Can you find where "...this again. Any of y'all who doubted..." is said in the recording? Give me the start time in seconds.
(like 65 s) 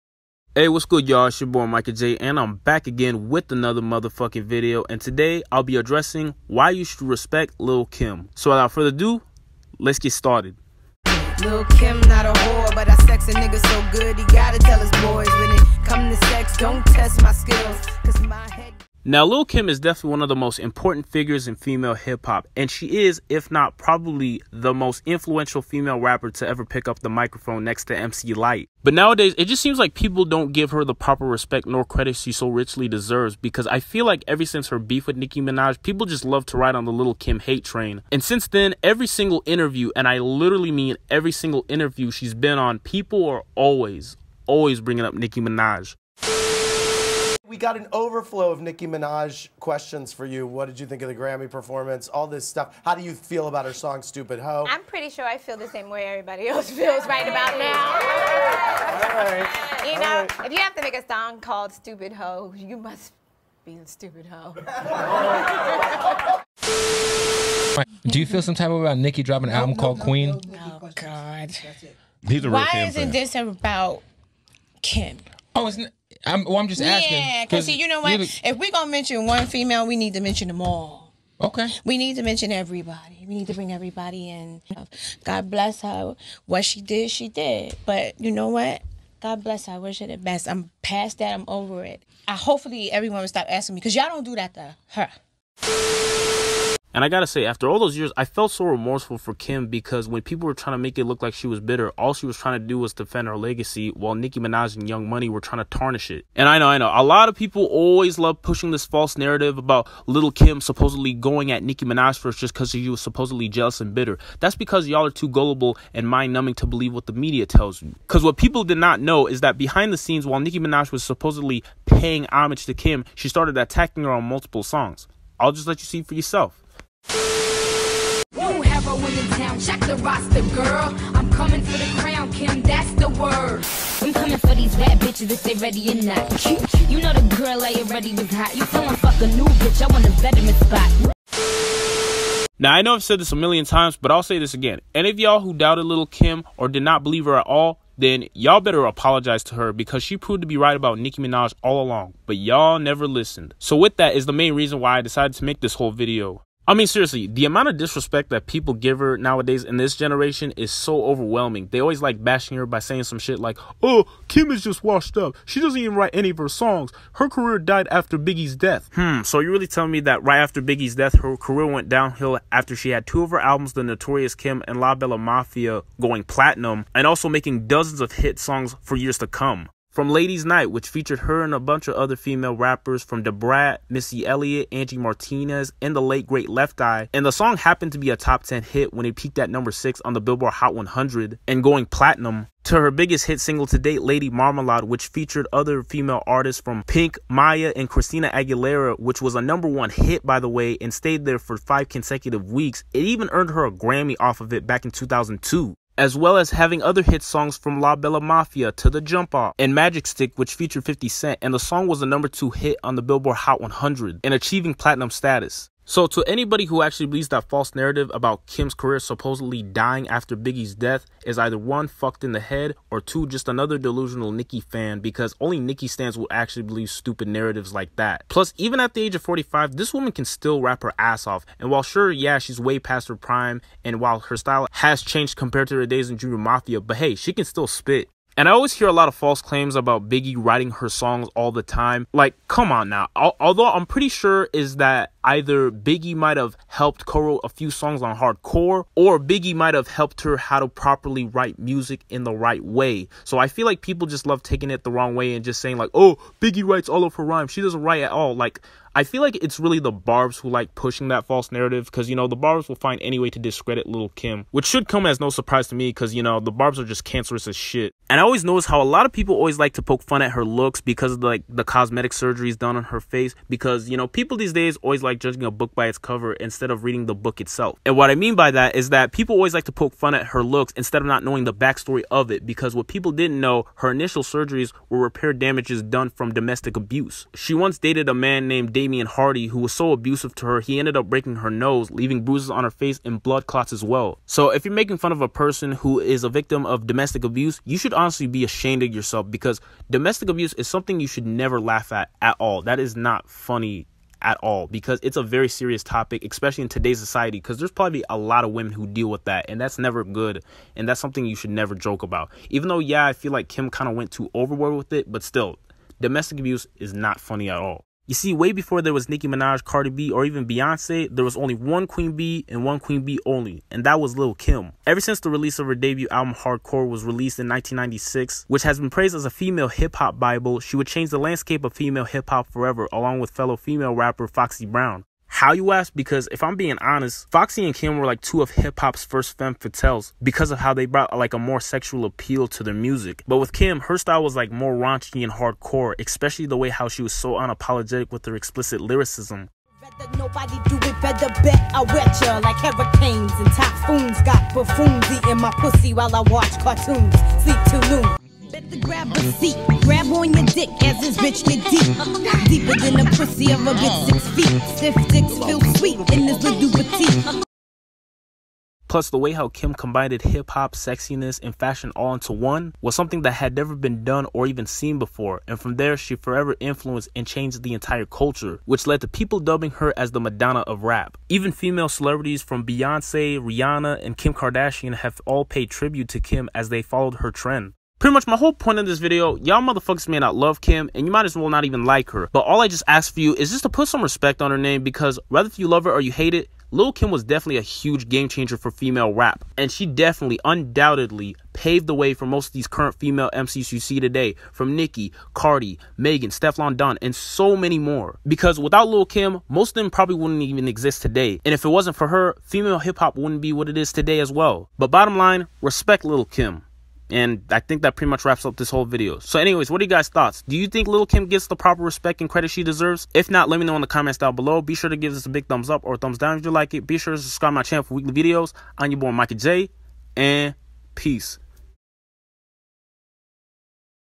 144 s.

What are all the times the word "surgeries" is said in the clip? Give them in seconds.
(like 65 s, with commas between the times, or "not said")
272 s, 284 s.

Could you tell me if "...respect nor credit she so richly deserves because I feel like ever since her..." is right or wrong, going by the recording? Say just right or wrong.
right.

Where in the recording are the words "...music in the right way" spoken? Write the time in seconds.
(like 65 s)
251 s.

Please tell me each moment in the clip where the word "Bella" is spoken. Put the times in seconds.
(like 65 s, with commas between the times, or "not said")
174 s, 207 s.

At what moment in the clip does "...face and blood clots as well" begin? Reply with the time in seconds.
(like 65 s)
292 s.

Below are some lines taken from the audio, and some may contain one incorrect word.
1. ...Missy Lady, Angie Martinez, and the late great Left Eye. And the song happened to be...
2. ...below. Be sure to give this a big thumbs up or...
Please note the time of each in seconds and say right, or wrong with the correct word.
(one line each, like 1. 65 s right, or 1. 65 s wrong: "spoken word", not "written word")
1. 183 s wrong: "Elliott", not "Lady"
2. 424 s right.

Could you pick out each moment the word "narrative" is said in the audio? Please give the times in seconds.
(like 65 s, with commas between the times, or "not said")
109 s, 217 s, 227 s, 261 s.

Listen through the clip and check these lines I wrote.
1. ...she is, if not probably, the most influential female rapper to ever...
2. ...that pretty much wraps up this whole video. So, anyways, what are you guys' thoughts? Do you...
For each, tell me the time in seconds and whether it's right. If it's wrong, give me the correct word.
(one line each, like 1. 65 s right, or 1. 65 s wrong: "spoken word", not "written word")
1. 22 s right
2. 417 s right.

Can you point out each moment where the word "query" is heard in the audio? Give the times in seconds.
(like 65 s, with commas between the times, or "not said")
not said.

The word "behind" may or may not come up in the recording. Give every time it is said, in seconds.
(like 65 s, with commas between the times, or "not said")
119 s.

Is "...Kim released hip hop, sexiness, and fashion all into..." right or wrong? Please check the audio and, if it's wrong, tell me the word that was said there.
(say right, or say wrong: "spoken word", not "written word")
wrong: "combined", not "released".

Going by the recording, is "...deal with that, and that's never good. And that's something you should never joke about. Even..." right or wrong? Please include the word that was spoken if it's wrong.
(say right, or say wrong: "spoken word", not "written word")
right.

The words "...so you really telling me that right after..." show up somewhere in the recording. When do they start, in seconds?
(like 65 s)
169 s.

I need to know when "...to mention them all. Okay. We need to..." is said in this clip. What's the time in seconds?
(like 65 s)
80 s.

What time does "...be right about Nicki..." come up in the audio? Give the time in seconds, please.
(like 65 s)
150 s.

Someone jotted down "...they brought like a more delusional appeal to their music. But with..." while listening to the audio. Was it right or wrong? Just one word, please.
wrong.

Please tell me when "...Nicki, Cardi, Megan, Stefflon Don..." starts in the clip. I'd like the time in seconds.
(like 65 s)
404 s.